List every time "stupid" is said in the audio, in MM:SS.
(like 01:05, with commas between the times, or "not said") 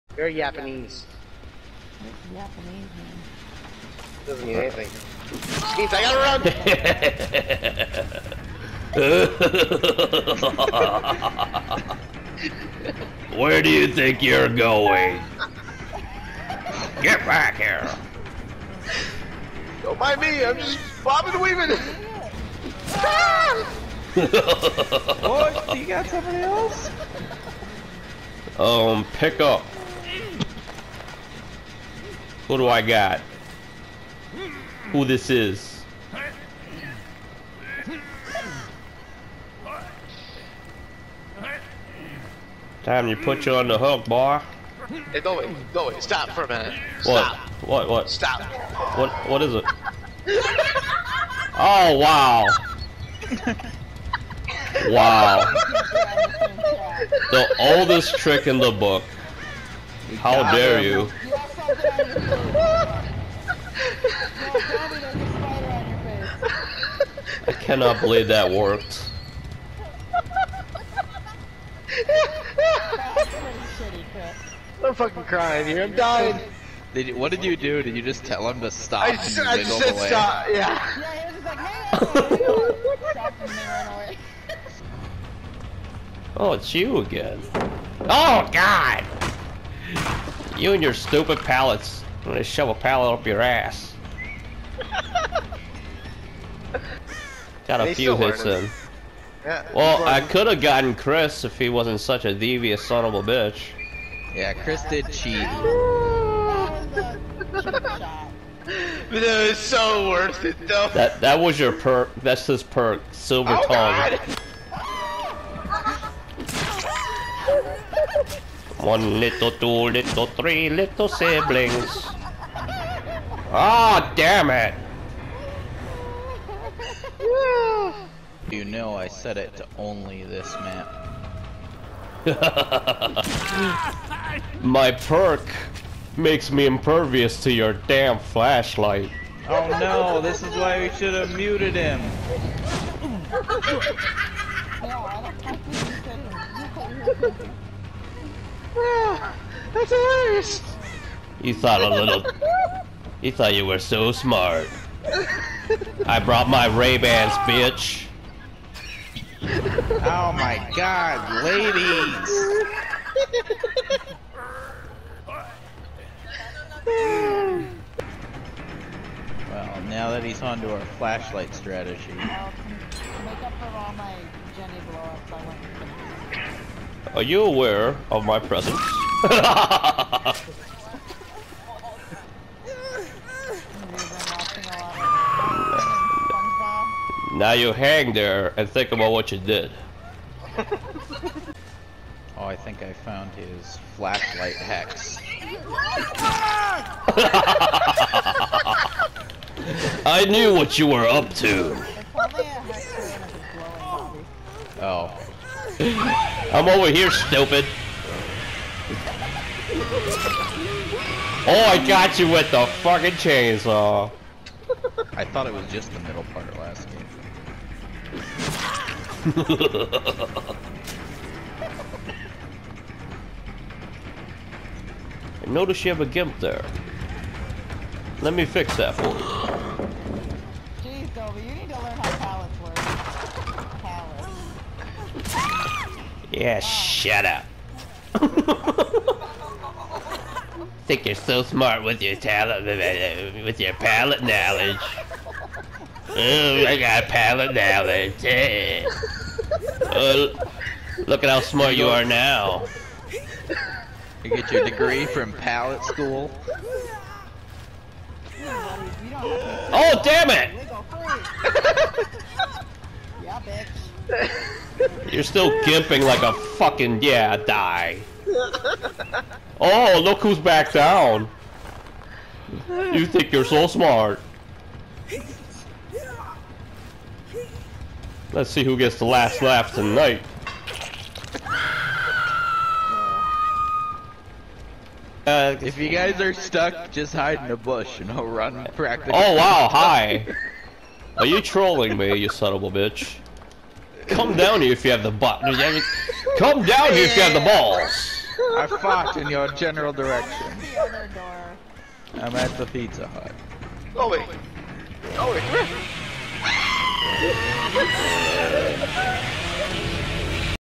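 01:30, 03:27.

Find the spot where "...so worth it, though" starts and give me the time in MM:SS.
01:49.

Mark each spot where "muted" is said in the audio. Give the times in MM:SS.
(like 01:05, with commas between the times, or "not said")
02:21.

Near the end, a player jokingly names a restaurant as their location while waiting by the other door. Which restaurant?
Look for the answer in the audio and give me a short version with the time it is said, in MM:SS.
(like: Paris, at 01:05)
Pizza Hut, at 05:02.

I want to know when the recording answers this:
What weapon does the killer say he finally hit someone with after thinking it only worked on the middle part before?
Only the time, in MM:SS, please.
03:33.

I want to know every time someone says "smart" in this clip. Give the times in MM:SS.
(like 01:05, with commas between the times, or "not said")
02:34, 04:01, 04:11, 04:33.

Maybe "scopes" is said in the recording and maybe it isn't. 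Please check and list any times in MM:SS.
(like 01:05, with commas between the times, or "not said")
not said.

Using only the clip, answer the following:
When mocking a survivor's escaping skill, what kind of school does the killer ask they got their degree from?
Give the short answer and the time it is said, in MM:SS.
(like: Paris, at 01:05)
Pallet school, at 04:15.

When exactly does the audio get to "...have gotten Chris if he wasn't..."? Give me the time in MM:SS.
01:40.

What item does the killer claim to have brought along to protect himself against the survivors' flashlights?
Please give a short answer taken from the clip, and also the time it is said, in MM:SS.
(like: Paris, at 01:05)
Ray Bans, at 02:36.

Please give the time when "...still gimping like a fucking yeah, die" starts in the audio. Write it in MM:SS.
04:25.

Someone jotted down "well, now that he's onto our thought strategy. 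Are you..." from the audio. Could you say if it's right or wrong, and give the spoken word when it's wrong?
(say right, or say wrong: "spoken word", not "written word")
wrong: "flashlight", not "thought".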